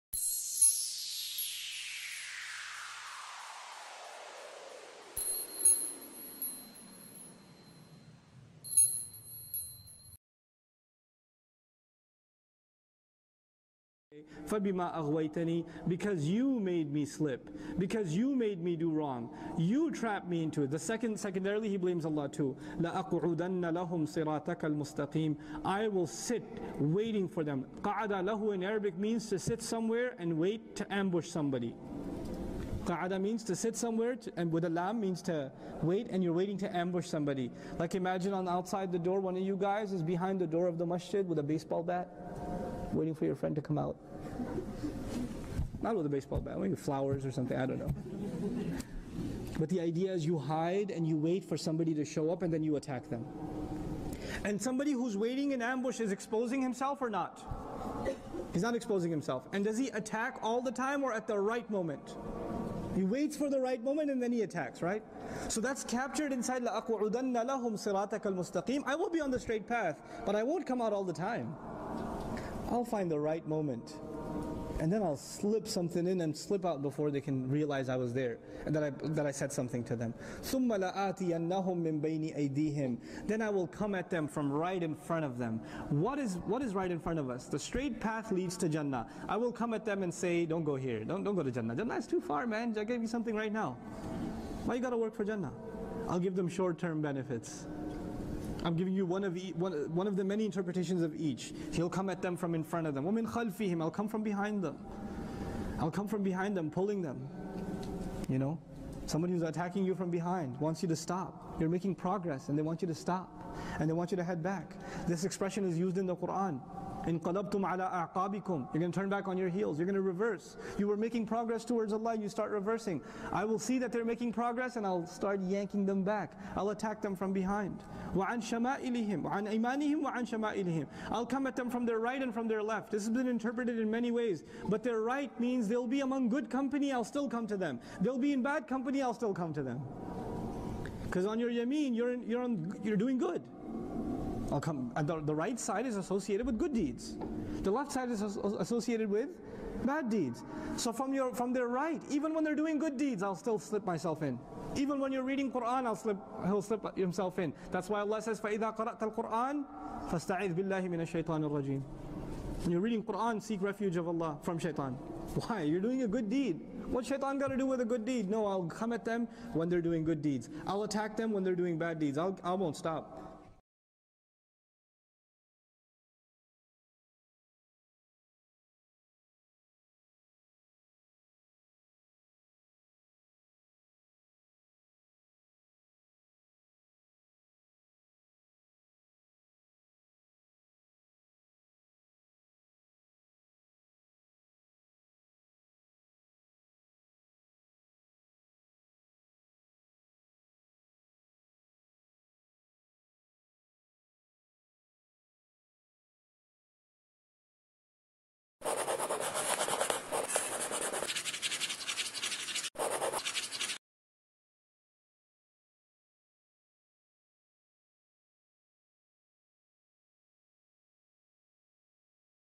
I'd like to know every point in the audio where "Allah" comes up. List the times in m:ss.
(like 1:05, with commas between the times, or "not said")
0:22, 2:01, 2:38, 2:44.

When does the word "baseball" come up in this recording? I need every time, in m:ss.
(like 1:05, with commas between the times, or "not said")
0:41, 0:46.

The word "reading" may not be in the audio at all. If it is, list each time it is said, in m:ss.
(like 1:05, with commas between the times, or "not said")
2:35, 2:42.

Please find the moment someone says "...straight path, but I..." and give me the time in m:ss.
1:09.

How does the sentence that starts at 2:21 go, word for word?
Because on your yameen, you're, in, you're, on, you're doing good.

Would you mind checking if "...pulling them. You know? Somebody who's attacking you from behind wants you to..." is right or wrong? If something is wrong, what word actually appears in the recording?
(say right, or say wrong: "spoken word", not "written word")
right.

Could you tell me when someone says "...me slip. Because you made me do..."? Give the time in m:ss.
0:16.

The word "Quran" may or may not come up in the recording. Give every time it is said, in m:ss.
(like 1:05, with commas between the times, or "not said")
1:56, 2:35, 2:43.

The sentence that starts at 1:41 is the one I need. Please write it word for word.
He'll come at them from in front of them.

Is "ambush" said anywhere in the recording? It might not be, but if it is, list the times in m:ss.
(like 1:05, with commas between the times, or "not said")
0:30, 0:36, 0:55.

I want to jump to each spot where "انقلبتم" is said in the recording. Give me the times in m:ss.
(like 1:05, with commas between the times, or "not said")
1:57.